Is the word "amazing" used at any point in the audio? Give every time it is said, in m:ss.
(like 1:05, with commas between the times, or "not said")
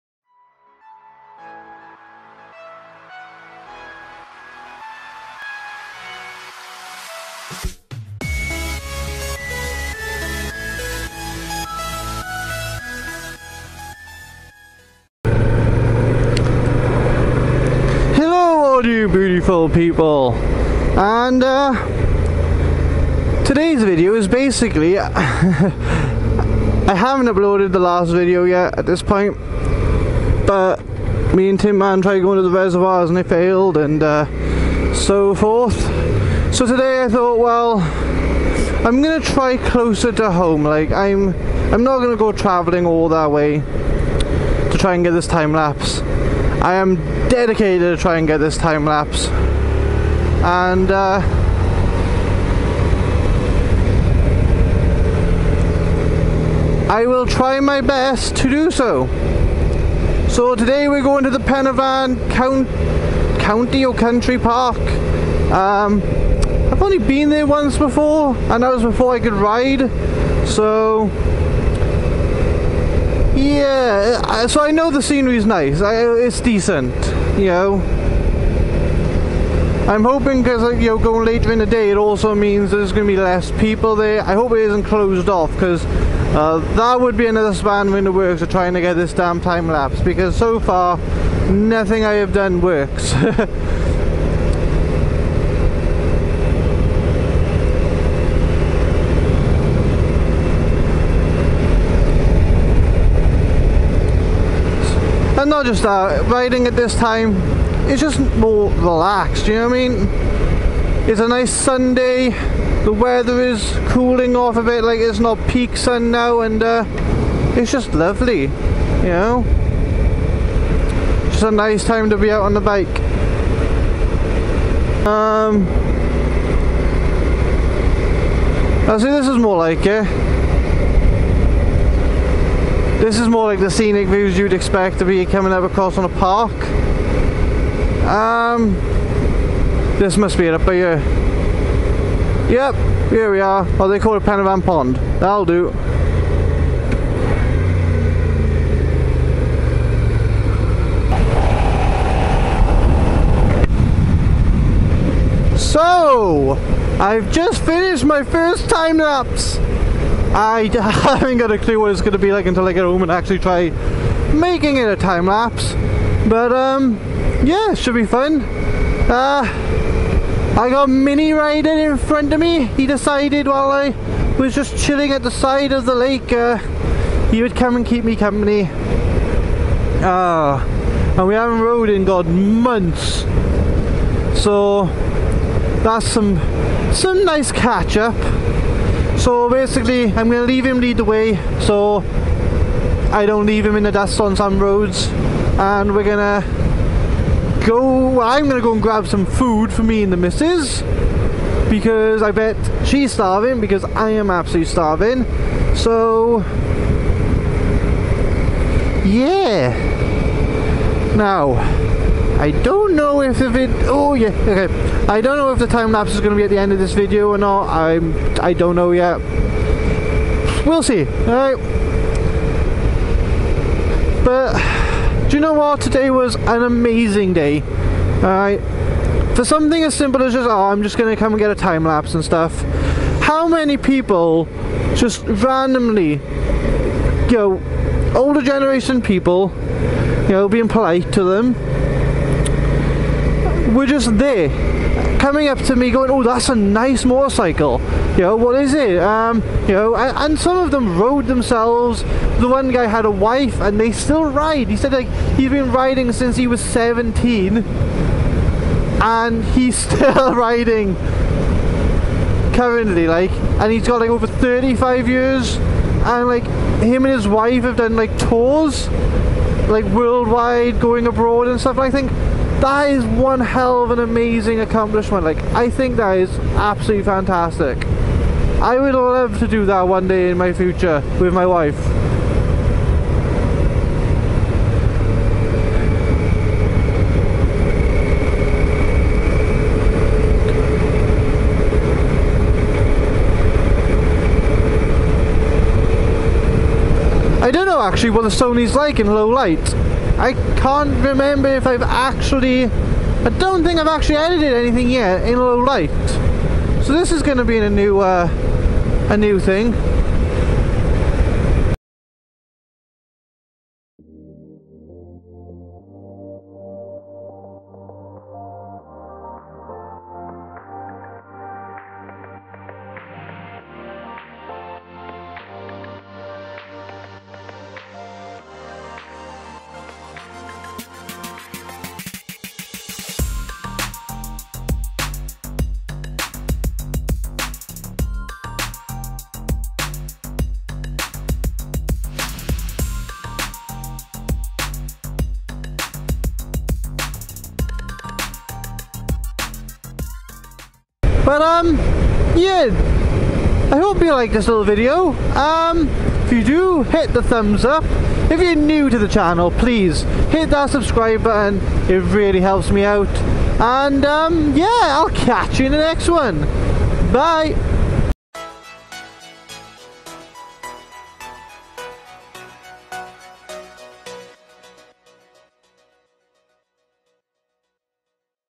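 3:46, 4:33.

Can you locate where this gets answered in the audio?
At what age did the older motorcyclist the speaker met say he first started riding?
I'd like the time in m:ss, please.
4:16.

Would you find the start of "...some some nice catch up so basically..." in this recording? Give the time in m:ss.
3:06.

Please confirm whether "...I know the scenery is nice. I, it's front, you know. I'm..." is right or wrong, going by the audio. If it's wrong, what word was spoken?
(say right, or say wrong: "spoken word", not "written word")
wrong: "decent", not "front".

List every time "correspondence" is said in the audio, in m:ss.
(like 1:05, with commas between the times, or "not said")
not said.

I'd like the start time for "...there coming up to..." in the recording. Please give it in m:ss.
4:04.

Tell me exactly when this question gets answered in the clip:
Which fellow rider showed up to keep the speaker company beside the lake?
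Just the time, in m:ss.
2:50.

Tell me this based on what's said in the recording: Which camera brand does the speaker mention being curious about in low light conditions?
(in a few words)
Sony.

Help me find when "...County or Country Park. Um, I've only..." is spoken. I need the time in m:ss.
1:03.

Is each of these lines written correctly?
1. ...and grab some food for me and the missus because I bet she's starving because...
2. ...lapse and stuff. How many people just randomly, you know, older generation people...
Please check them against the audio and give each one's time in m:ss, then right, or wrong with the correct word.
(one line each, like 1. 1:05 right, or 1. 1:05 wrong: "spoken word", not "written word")
1. 3:18 right
2. 3:51 right.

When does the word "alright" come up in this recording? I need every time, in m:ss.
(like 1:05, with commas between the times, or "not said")
3:41, 3:48.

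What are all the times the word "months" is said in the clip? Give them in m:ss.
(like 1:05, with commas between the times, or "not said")
3:02.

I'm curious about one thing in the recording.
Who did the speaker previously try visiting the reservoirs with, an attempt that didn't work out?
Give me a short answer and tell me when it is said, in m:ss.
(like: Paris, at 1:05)
Tim Man, at 0:31.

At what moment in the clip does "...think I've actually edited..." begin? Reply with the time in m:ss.
5:03.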